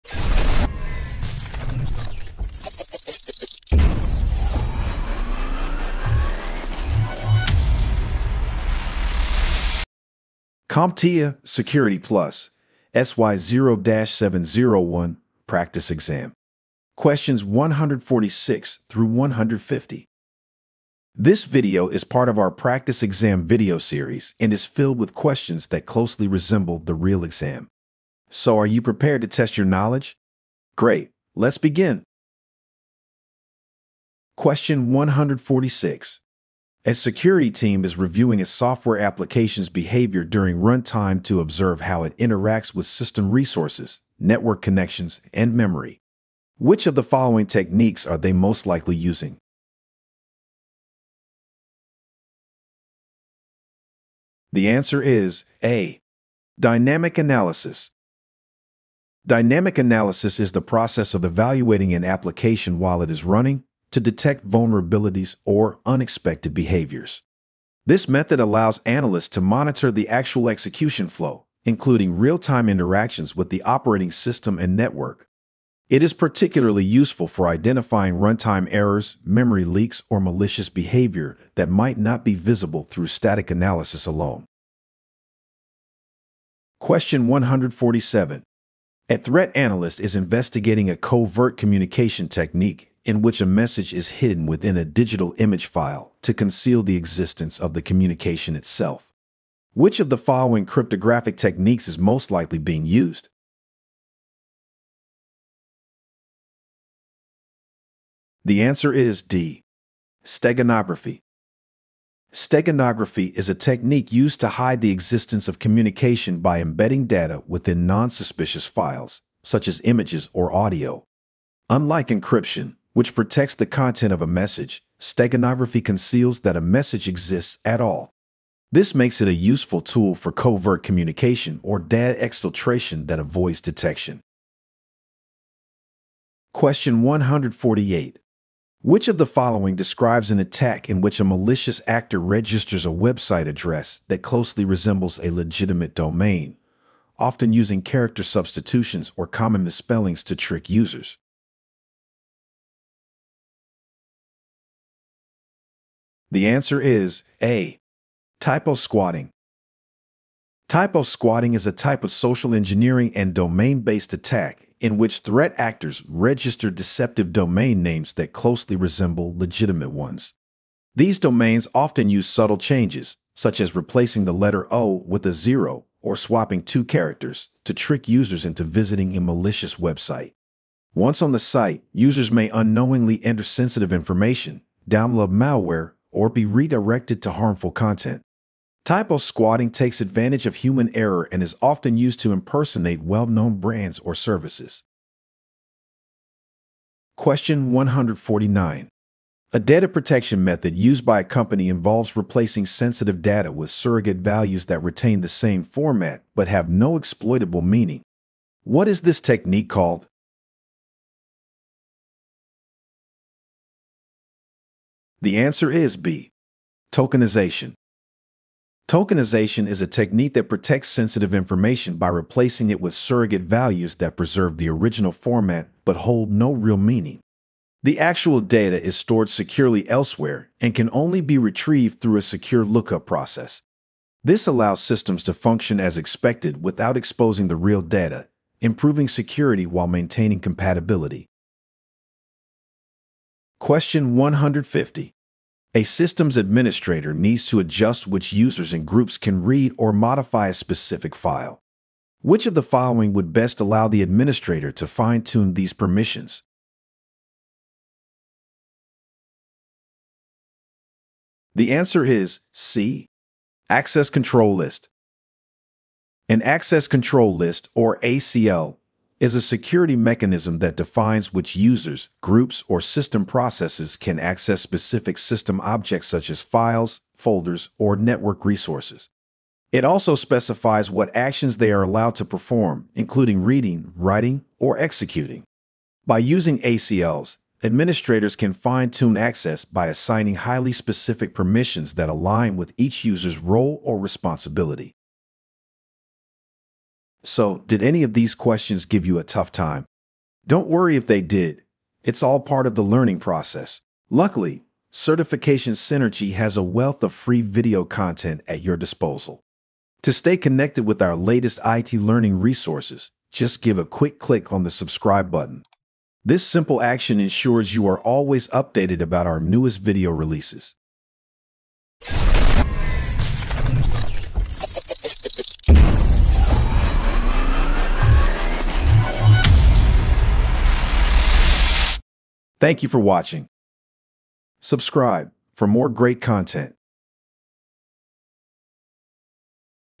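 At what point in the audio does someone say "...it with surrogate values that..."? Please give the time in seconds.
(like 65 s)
222 s.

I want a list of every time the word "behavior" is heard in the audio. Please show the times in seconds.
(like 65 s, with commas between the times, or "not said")
39 s, 66 s, 80 s.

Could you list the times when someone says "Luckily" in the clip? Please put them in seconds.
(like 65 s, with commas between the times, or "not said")
304 s.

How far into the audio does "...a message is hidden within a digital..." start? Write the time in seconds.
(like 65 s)
93 s.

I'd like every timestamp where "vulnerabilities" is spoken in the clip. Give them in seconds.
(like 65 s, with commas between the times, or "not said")
64 s.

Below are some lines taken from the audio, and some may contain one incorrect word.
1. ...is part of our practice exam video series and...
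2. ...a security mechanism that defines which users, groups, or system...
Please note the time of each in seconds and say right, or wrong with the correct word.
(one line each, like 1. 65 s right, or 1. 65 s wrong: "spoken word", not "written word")
1. 21 s right
2. 269 s right.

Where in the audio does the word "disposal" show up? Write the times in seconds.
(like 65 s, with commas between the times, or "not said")
308 s.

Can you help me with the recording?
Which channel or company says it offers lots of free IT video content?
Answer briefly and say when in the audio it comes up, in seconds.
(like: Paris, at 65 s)
Certification Cynergy, at 304 s.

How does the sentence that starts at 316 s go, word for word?
This simple action ensures you are always updated about our newest video releases.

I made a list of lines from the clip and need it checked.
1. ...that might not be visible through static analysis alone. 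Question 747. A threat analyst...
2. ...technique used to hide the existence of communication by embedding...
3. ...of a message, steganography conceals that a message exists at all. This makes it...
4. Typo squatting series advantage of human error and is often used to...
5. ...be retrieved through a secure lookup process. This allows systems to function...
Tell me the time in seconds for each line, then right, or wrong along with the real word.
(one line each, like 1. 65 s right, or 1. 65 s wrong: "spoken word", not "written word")
1. 81 s wrong: "147", not "747"
2. 113 s right
3. 124 s right
4. 188 s wrong: "takes", not "series"
5. 231 s right.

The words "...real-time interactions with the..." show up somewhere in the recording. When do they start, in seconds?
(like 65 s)
72 s.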